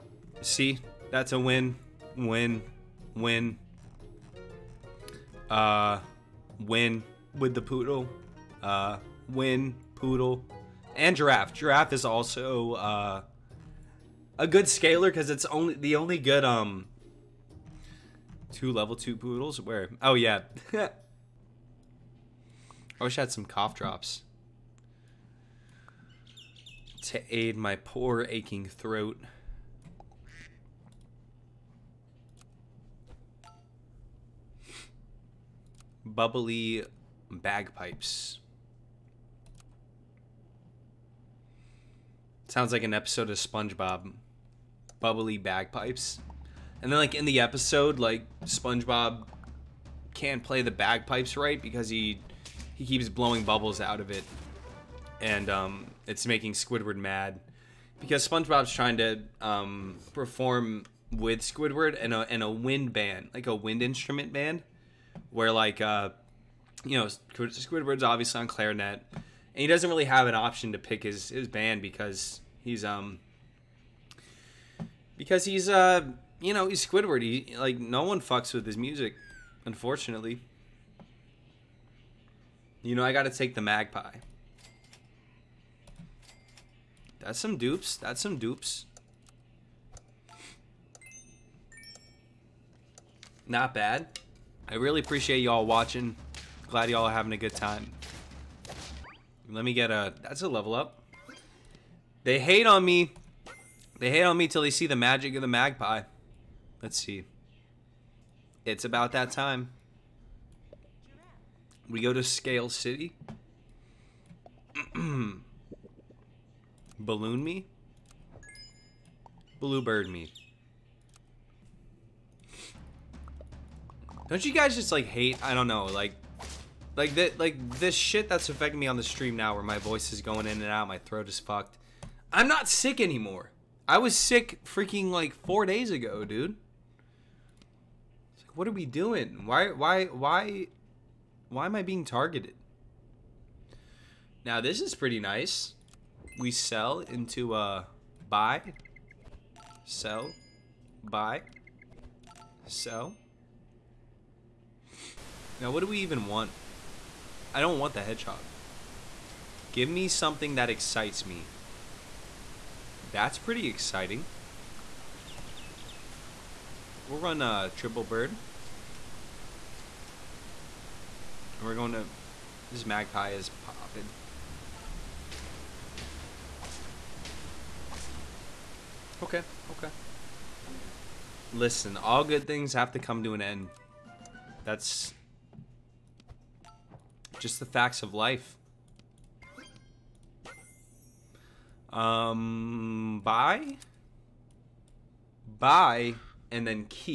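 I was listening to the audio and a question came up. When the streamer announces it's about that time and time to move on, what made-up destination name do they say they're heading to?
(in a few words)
Scale City.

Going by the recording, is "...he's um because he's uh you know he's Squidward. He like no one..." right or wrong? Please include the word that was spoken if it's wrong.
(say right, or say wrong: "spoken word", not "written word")
right.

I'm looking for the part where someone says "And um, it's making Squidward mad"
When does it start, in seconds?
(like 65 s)
55 s.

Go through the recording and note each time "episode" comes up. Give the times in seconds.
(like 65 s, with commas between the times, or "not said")
42 s, 47 s.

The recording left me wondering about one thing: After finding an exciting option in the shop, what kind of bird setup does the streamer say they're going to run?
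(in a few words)
triple bird.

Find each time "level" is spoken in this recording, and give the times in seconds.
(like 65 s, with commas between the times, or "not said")
18 s, 100 s.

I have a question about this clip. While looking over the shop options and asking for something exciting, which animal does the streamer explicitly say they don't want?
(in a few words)
hedgehog.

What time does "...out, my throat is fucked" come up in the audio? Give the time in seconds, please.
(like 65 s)
130 s.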